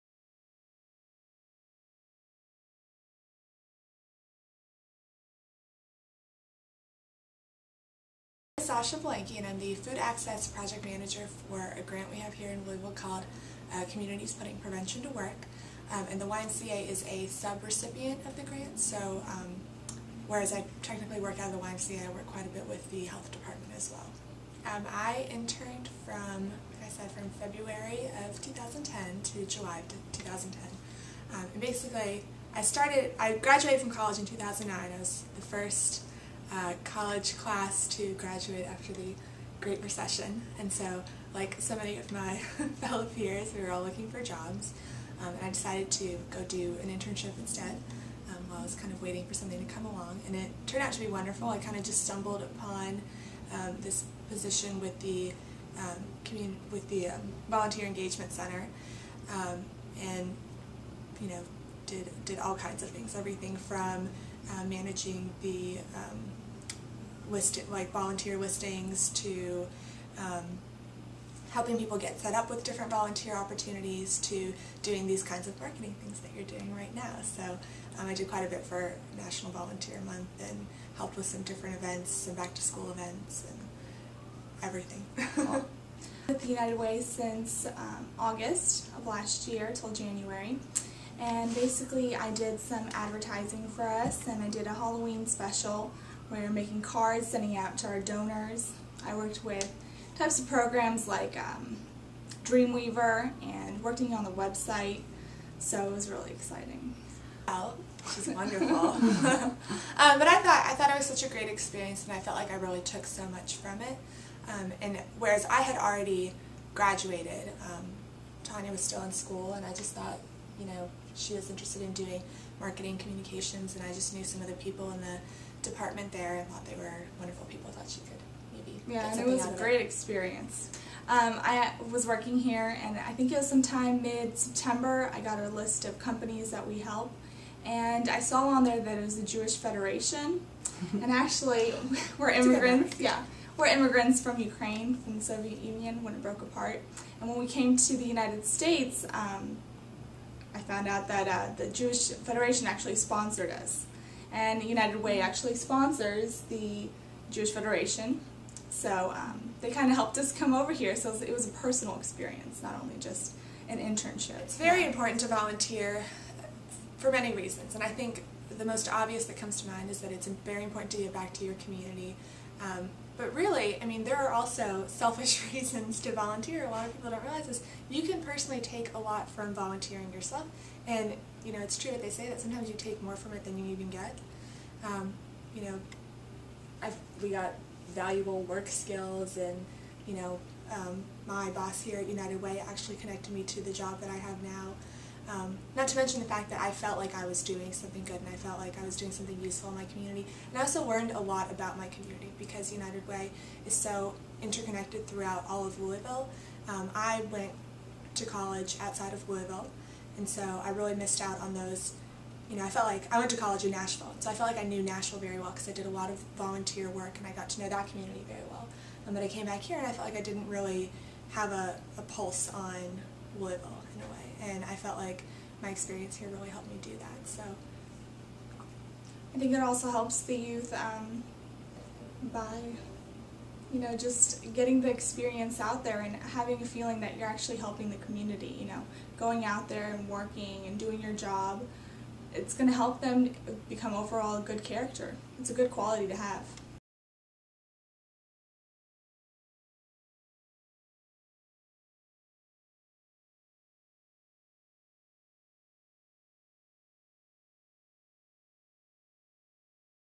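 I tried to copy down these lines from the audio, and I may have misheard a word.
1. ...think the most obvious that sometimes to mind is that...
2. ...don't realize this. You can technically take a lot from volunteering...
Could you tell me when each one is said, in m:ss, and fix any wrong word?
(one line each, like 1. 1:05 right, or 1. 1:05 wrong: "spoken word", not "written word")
1. 2:47 wrong: "comes", not "sometimes"
2. 2:57 wrong: "personally", not "technically".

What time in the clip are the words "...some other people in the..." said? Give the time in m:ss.
2:04.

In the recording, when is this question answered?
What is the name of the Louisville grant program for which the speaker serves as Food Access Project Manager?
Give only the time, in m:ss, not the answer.
0:13.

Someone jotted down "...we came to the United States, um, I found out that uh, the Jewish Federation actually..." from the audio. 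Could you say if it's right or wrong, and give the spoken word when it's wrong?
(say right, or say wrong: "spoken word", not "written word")
right.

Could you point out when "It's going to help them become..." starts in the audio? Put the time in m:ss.
4:02.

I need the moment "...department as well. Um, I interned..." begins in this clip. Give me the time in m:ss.
0:23.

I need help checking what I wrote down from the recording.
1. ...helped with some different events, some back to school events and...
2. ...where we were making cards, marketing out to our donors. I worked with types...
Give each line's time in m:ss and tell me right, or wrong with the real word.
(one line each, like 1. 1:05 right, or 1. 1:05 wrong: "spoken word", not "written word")
1. 1:20 right
2. 1:36 wrong: "sending", not "marketing".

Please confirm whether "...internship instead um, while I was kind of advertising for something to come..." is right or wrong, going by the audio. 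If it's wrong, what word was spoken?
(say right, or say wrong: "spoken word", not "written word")
wrong: "waiting", not "advertising".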